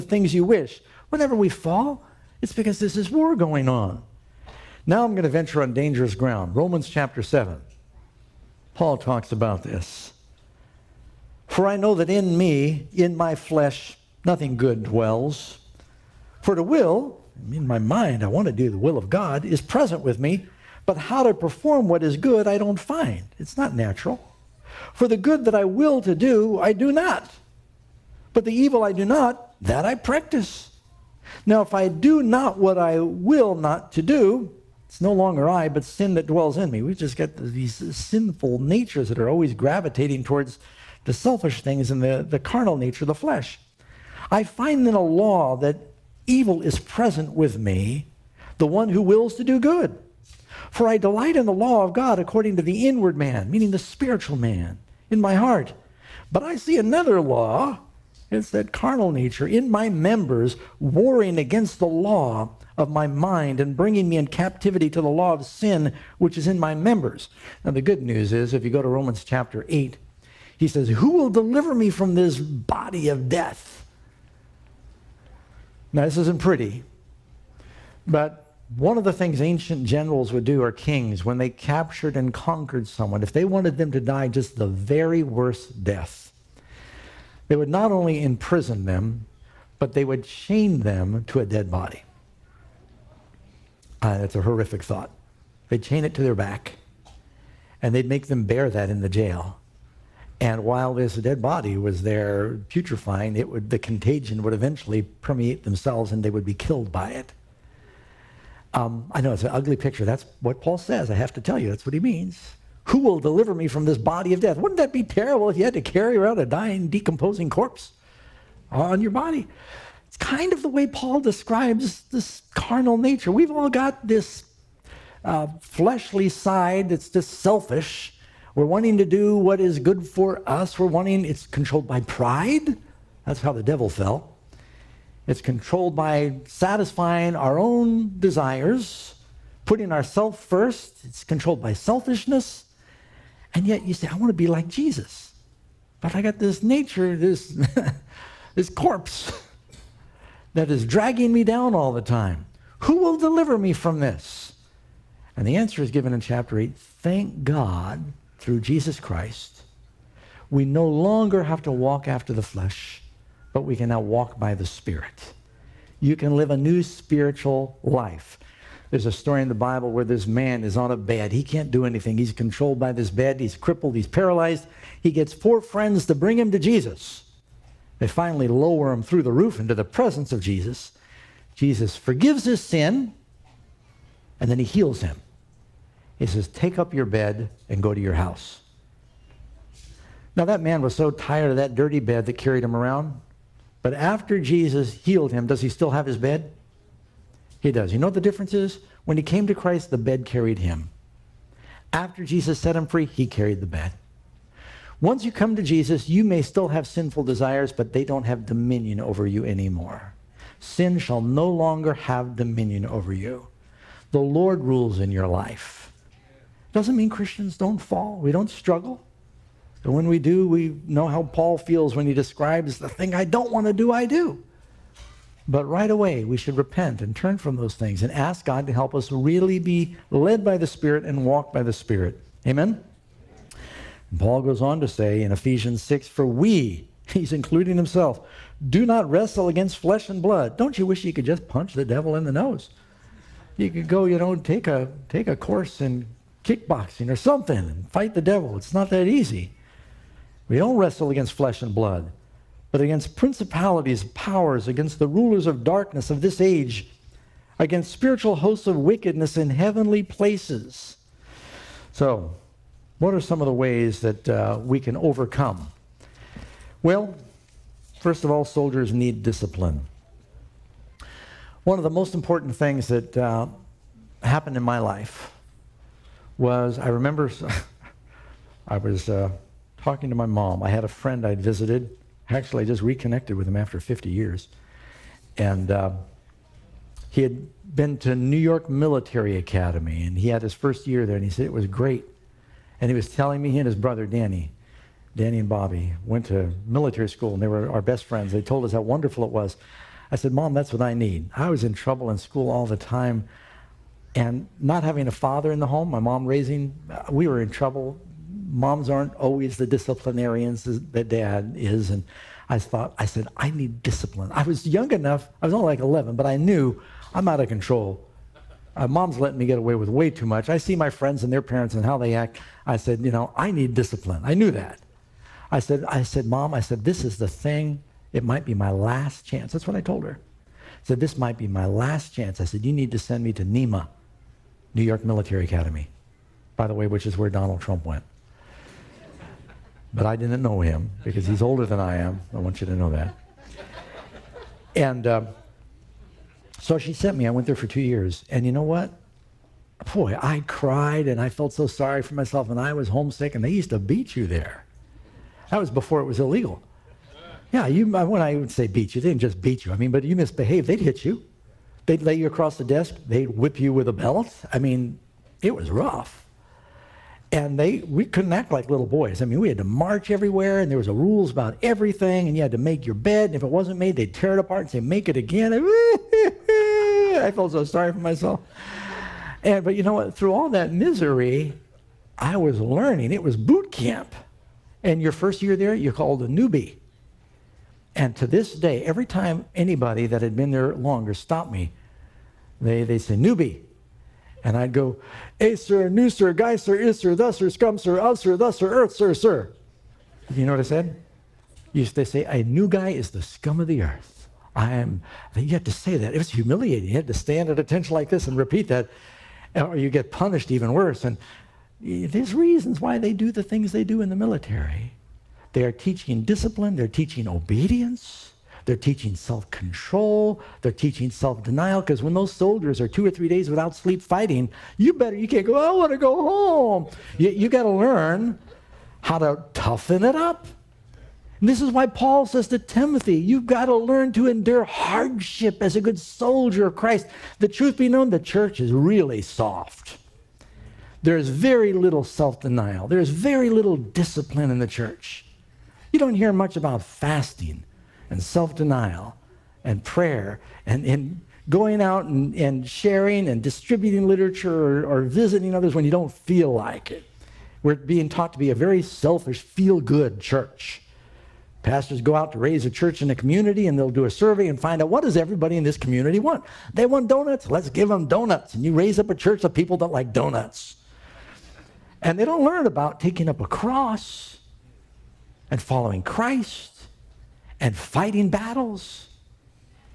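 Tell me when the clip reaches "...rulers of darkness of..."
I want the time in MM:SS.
04:15.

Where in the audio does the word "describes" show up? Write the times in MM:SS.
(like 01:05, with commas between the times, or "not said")
02:01, 03:42.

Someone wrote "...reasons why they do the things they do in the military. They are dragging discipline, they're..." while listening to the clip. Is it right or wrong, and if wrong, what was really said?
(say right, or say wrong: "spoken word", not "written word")
wrong: "teaching", not "dragging".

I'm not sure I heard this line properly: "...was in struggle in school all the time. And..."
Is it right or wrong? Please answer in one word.
wrong.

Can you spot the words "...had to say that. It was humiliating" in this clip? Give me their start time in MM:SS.
06:45.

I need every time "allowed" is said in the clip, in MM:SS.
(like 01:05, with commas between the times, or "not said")
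not said.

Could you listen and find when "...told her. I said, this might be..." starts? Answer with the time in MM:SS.
05:29.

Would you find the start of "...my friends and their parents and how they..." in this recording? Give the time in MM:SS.
05:20.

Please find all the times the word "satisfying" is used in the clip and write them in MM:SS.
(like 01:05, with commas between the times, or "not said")
02:16.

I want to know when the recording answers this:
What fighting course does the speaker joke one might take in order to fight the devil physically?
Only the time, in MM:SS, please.
04:06.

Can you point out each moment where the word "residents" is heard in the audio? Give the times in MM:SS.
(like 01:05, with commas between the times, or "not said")
not said.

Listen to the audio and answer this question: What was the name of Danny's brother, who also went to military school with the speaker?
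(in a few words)
Bobby.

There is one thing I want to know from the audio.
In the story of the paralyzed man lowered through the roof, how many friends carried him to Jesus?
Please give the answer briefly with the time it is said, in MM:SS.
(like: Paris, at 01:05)
4, at 02:55.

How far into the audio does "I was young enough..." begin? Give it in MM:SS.
05:14.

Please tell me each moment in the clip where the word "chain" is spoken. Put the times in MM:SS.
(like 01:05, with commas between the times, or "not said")
01:30, 01:35.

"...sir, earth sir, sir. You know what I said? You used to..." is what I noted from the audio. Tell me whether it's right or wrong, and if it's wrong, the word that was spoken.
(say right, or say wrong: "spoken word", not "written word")
right.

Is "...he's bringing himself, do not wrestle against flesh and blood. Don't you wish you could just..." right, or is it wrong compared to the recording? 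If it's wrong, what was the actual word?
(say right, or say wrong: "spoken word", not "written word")
wrong: "including", not "bringing".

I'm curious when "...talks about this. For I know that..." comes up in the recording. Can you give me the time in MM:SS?
00:08.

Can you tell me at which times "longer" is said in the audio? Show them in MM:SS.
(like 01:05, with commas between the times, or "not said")
00:35, 02:40, 03:31, 06:30.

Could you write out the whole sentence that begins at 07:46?
They want donuts, let's give them donuts.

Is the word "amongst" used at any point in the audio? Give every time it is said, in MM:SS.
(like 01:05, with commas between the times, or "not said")
not said.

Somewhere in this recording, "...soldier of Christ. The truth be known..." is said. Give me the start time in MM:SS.
07:15.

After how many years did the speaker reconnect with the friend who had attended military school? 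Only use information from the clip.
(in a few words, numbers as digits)
50.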